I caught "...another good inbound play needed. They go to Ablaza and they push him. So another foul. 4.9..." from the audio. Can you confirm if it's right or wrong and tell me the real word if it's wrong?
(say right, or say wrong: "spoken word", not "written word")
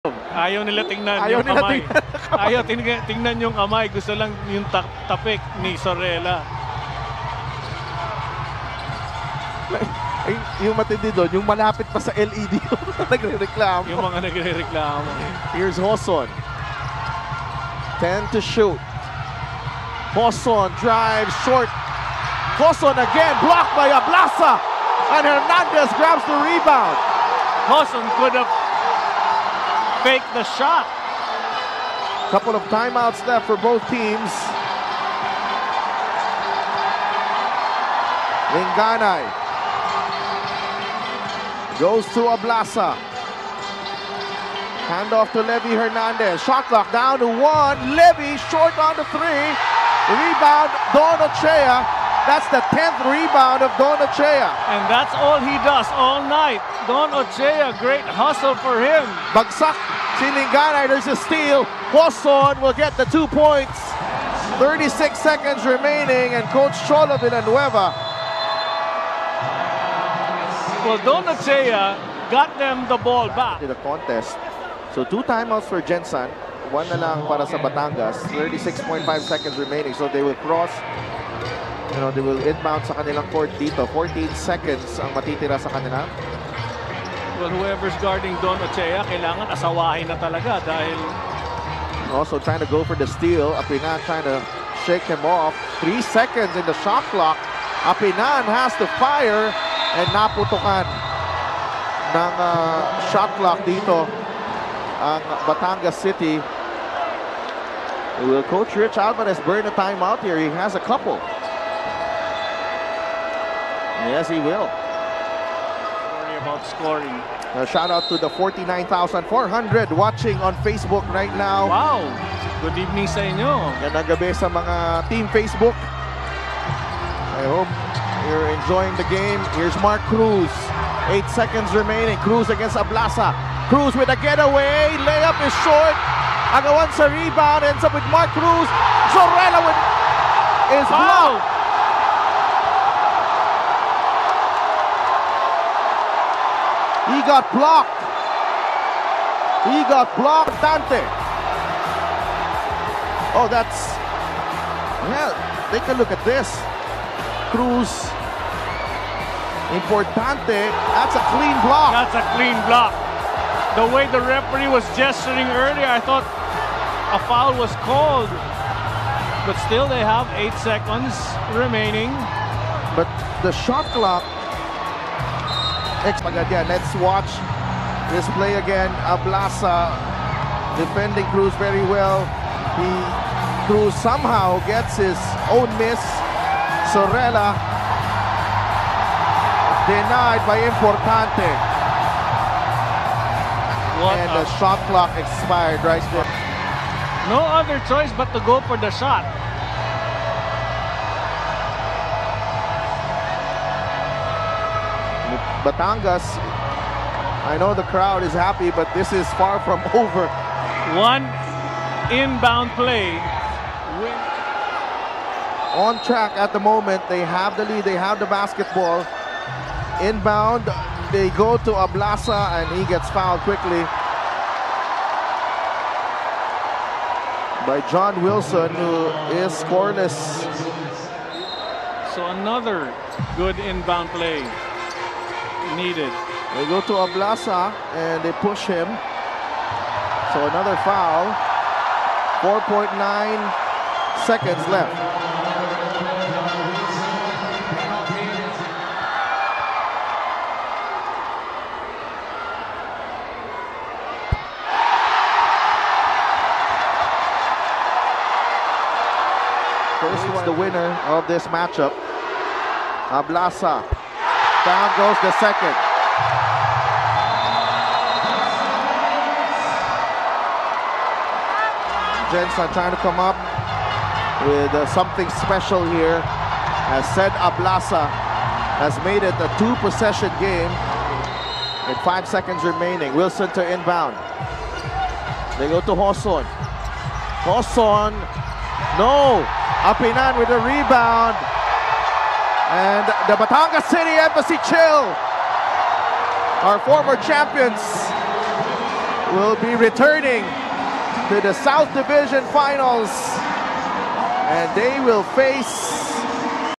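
right.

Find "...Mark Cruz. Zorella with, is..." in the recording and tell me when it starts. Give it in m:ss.
2:18.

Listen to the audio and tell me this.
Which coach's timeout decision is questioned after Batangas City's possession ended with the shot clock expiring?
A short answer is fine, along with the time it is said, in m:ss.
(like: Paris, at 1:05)
Rich Alvarez, at 1:48.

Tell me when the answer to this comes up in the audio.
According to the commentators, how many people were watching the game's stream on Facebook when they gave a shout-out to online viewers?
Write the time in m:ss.
1:58.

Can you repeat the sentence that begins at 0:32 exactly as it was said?
Couple of timeouts left for both teams.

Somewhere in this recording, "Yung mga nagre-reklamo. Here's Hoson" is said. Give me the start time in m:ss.
0:13.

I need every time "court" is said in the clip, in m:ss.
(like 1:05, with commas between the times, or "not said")
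1:23.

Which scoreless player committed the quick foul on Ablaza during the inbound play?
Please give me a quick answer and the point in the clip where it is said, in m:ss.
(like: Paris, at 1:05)
John Wilson, at 3:47.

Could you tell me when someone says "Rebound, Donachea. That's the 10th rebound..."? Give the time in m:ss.
0:50.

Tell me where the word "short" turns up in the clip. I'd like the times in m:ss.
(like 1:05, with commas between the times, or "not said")
0:21, 0:48, 2:15.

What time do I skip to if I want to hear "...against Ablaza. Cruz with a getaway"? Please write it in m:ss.
2:12.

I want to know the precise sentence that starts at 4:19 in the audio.
First one, the winner of this matchup, Ablaza.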